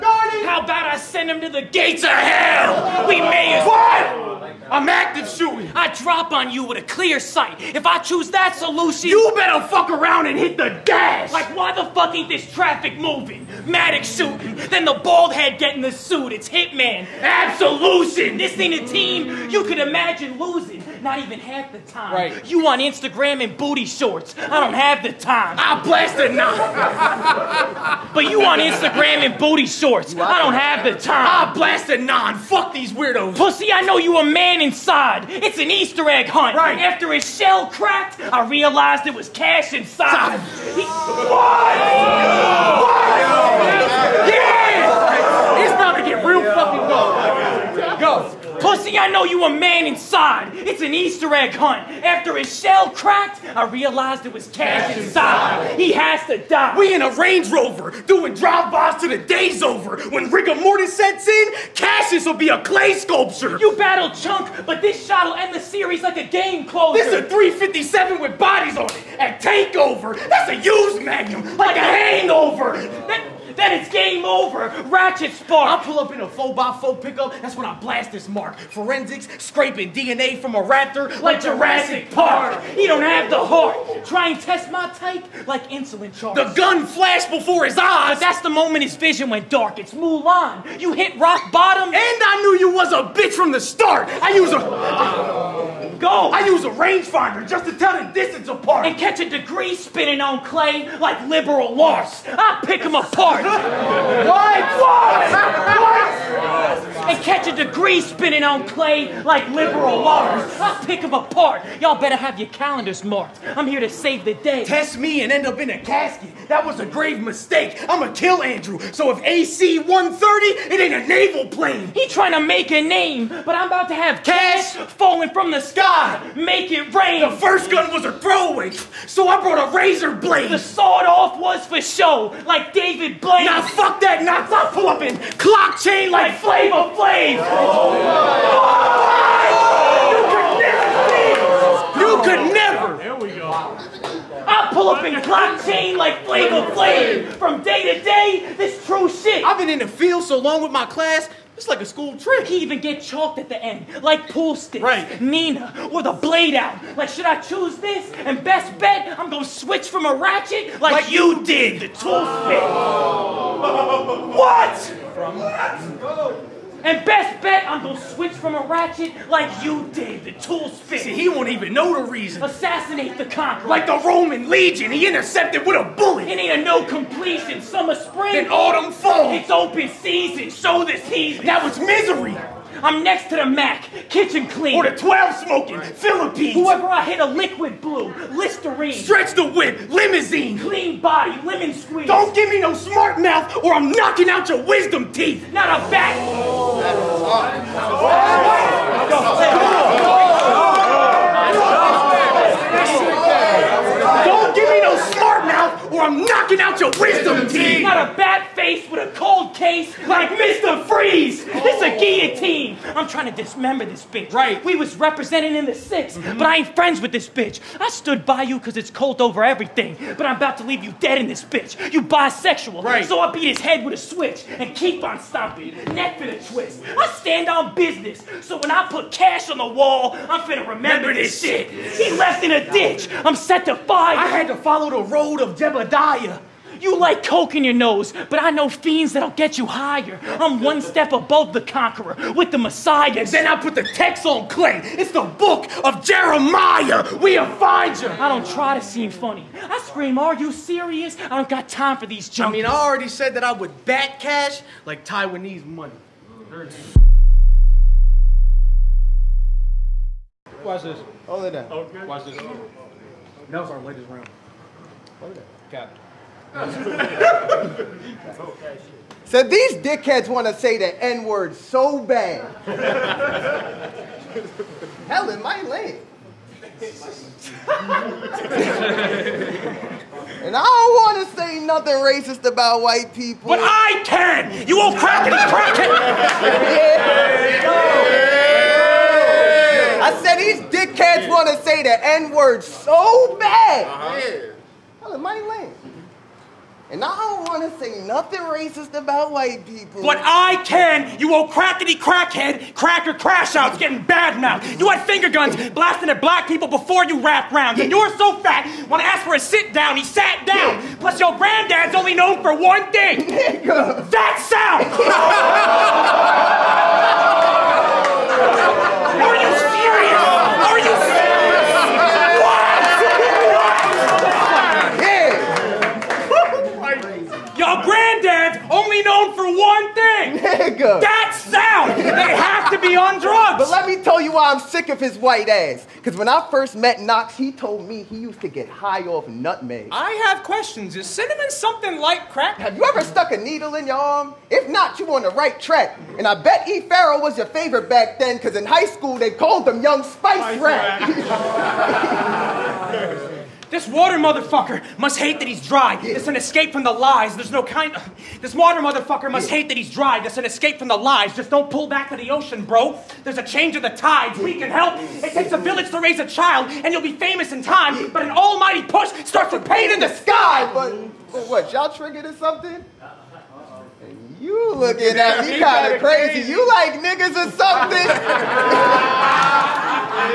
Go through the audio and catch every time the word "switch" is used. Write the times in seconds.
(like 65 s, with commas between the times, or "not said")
159 s, 167 s, 224 s.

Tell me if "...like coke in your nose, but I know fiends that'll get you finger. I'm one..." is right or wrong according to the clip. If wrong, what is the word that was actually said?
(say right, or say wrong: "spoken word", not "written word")
wrong: "higher", not "finger".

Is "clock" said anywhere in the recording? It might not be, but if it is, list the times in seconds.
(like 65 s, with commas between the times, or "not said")
135 s, 145 s.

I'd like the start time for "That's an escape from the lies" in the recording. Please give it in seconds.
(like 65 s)
360 s.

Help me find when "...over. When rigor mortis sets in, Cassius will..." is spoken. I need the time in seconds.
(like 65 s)
59 s.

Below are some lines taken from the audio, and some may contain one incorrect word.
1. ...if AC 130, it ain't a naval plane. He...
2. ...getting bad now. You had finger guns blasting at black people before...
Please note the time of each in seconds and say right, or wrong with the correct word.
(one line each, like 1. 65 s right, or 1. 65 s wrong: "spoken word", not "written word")
1. 119 s right
2. 303 s right.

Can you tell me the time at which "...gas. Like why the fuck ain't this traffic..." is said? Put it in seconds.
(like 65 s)
10 s.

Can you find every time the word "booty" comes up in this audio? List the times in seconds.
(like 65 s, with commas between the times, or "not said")
23 s, 29 s.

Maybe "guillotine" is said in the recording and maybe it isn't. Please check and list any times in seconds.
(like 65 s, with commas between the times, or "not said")
211 s.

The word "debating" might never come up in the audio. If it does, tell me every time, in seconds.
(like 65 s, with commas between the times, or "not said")
not said.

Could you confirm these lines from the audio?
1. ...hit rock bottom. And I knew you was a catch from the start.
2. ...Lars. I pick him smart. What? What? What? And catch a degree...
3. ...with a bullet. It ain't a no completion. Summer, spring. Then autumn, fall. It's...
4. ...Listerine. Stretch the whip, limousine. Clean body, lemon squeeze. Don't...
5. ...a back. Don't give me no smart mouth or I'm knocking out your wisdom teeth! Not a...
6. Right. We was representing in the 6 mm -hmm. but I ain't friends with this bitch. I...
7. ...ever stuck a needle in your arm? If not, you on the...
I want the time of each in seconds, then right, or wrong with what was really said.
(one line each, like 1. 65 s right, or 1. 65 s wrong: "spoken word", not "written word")
1. 90 s wrong: "bitch", not "catch"
2. 101 s wrong: "apart", not "smart"
3. 175 s right
4. 188 s right
5. 195 s right
6. 214 s right
7. 342 s right.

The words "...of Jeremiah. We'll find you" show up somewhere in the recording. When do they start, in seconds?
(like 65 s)
245 s.